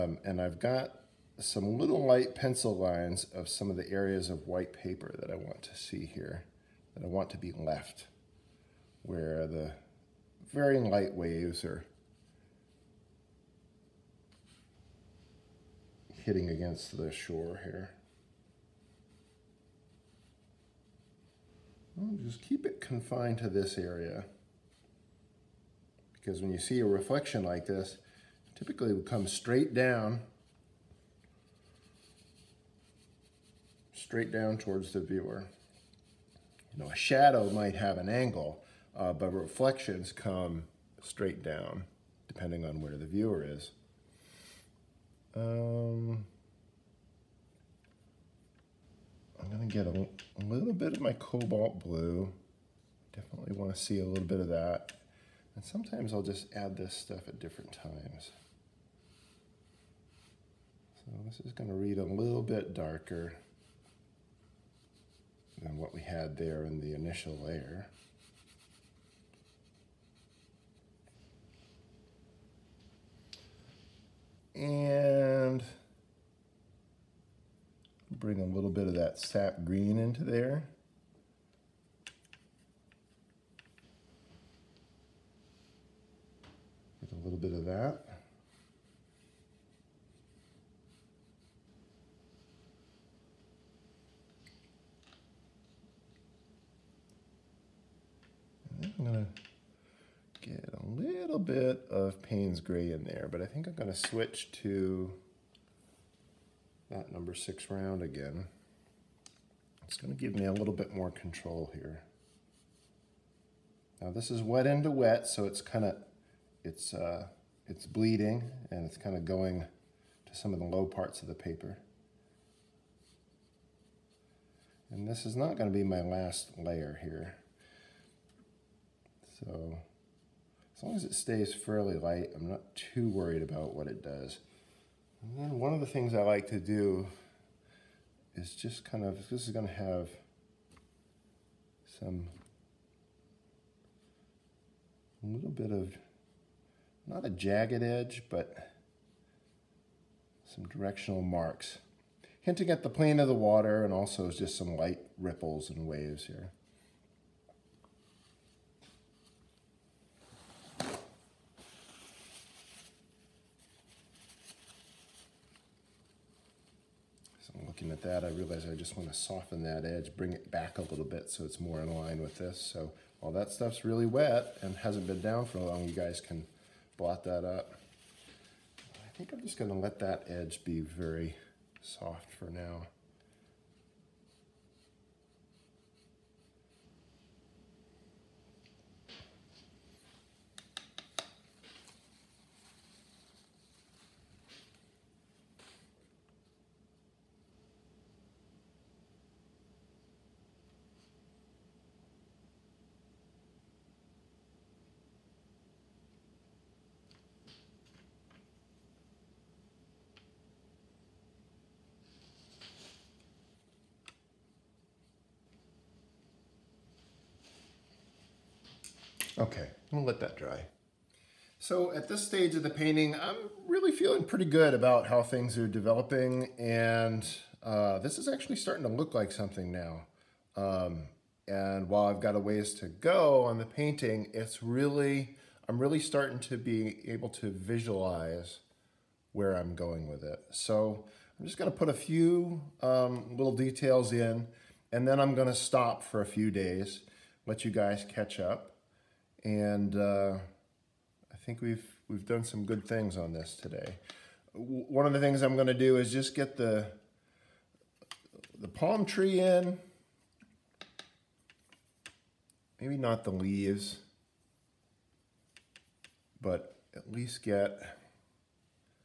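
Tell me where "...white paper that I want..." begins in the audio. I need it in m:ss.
0:04.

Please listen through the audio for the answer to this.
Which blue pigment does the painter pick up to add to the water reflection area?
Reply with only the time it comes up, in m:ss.
0:51.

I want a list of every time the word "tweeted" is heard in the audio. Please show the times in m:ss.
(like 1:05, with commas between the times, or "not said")
not said.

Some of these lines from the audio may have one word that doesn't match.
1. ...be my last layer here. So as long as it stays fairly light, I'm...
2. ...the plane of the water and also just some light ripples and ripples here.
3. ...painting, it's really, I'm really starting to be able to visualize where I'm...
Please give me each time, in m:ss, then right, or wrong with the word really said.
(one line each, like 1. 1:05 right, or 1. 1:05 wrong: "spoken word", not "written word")
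1. 2:05 right
2. 2:32 wrong: "waves", not "ripples"
3. 3:53 right.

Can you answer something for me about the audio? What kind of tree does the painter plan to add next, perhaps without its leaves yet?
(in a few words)
palm tree.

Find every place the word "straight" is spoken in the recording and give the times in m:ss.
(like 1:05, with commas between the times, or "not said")
0:29, 0:33, 0:41.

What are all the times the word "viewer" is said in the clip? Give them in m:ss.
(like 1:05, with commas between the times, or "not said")
0:35, 0:43.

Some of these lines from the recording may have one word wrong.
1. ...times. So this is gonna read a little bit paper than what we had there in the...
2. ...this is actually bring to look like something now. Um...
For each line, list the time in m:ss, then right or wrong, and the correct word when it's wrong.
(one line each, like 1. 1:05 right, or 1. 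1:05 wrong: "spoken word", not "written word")
1. 0:57 wrong: "darker", not "paper"
2. 3:47 wrong: "starting", not "bring".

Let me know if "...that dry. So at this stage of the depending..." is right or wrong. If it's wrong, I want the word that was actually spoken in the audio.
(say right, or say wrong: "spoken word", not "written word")
wrong: "painting", not "depending".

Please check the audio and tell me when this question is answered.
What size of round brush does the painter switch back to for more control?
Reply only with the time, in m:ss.
1:47.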